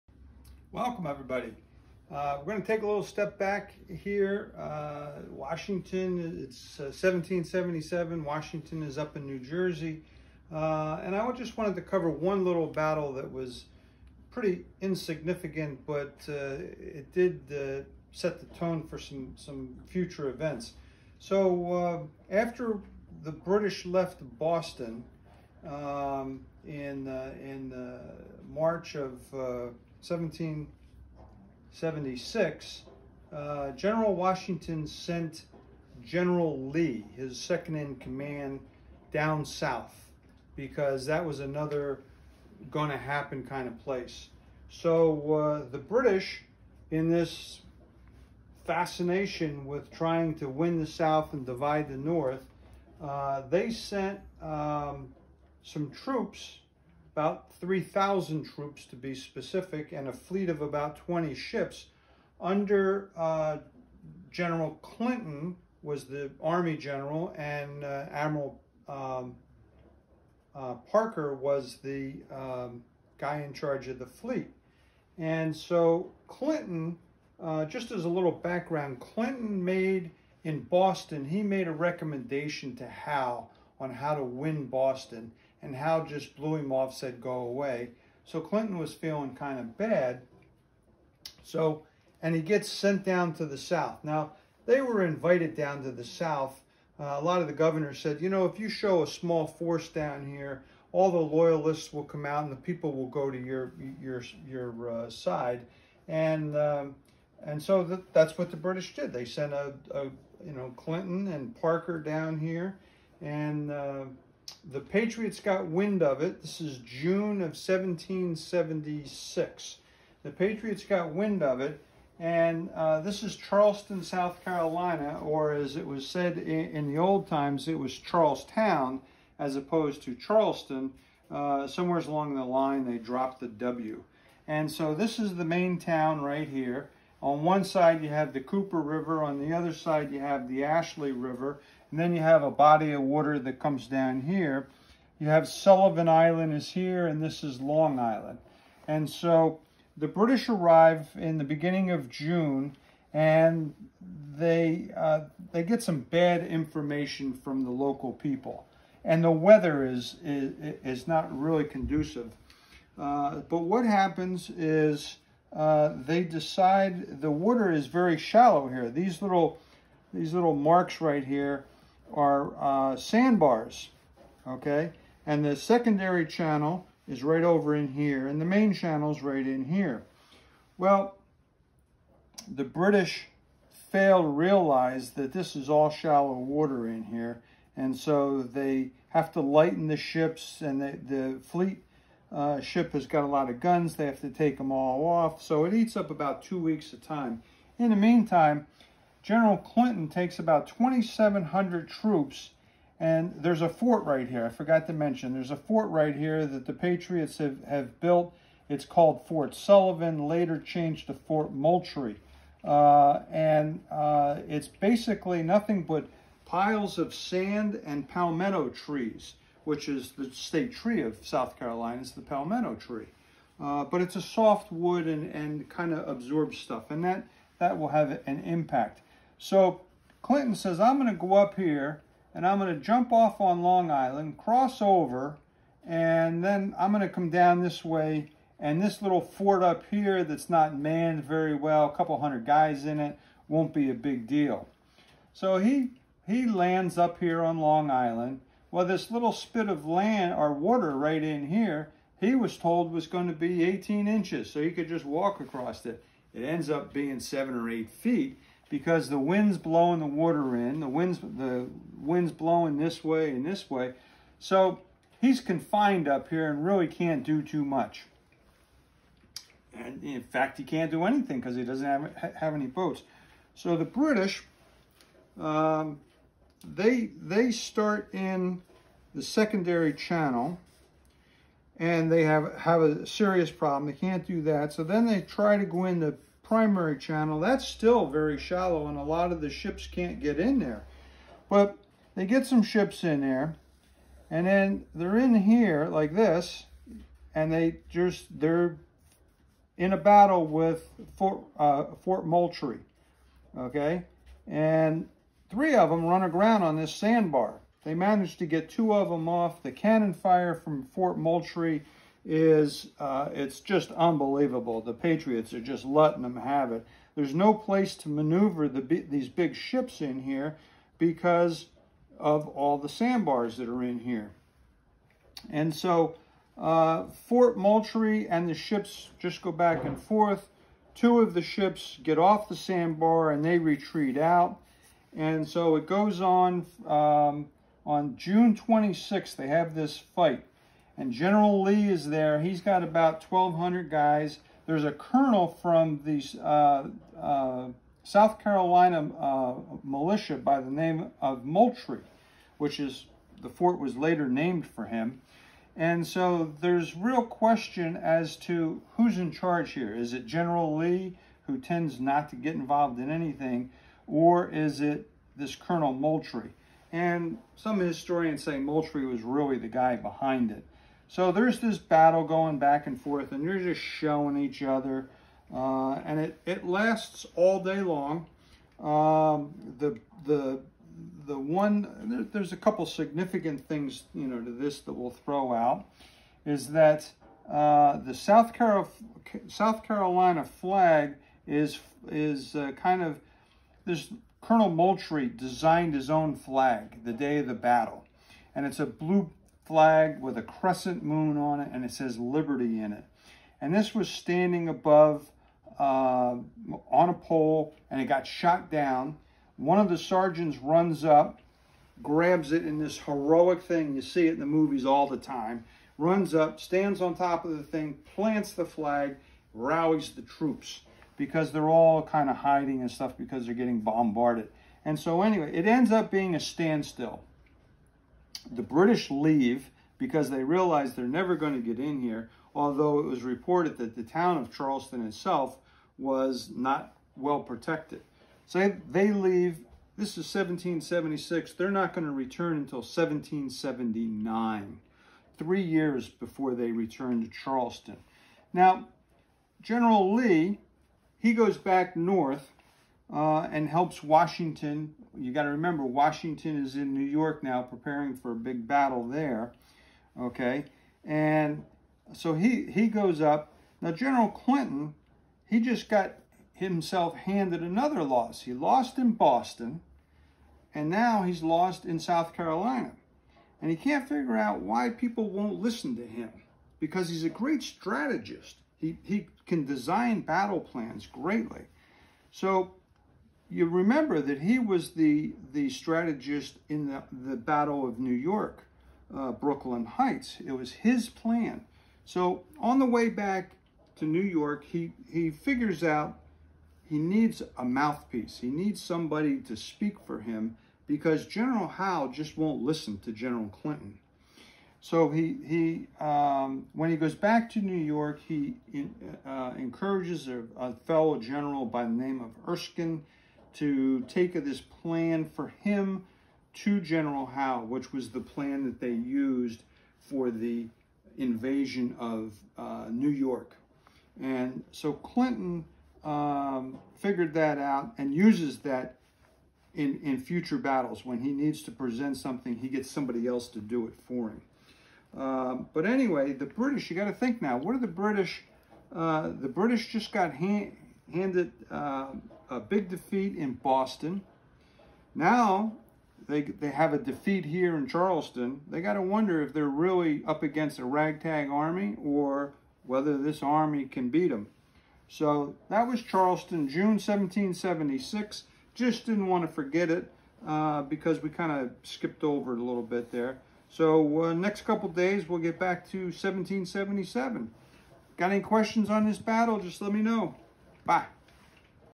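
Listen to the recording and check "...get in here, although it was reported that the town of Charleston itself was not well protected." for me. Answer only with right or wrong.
right.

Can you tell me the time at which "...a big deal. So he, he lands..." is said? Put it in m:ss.
4:03.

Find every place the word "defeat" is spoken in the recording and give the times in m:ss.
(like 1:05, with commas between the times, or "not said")
9:02, 9:06.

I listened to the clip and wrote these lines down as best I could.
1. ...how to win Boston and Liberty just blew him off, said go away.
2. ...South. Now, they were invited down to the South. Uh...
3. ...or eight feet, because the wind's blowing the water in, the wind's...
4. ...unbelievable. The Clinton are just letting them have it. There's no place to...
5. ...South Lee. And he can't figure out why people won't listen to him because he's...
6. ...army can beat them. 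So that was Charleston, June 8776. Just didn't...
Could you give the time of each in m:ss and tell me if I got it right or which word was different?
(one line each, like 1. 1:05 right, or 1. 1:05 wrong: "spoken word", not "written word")
1. 1:23 wrong: "Howe", not "Liberty"
2. 1:33 right
3. 4:17 right
4. 5:13 wrong: "Patriots", not "Clinton"
5. 7:51 wrong: "Carolina", not "Lee"
6. 9:13 wrong: "1776", not "8776".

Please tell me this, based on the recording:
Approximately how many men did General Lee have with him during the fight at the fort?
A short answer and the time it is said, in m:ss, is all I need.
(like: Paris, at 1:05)
1,200, at 5:43.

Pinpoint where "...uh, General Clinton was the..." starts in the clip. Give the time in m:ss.
1:03.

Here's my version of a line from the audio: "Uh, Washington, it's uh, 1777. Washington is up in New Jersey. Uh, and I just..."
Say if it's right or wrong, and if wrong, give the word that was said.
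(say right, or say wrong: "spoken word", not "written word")
right.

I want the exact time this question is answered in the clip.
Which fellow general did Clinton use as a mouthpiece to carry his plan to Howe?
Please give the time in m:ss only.
8:32.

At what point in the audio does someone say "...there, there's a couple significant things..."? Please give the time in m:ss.
6:22.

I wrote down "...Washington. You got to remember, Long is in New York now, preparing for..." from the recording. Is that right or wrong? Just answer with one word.
wrong.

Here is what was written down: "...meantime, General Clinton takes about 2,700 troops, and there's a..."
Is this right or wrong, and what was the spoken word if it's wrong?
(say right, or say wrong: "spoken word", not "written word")
right.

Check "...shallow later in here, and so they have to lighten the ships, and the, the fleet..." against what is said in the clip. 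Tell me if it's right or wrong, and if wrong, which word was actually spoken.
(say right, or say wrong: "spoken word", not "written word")
wrong: "water", not "later".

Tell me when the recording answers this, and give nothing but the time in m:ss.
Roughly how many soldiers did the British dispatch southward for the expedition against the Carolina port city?
0:57.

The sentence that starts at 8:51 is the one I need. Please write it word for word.
When he needs to present something, he gets somebody else to do it for him.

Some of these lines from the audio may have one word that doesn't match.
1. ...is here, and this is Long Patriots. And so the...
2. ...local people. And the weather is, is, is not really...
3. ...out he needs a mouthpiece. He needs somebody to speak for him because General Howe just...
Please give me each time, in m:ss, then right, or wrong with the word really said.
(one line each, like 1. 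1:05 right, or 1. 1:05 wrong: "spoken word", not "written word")
1. 2:26 wrong: "Island", not "Patriots"
2. 2:37 right
3. 8:15 right.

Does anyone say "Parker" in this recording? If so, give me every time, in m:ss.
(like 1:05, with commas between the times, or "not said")
1:10, 1:51.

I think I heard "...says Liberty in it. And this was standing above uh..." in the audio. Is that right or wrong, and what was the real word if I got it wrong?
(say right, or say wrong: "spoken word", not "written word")
right.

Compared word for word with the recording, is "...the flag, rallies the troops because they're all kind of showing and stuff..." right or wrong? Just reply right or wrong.
wrong.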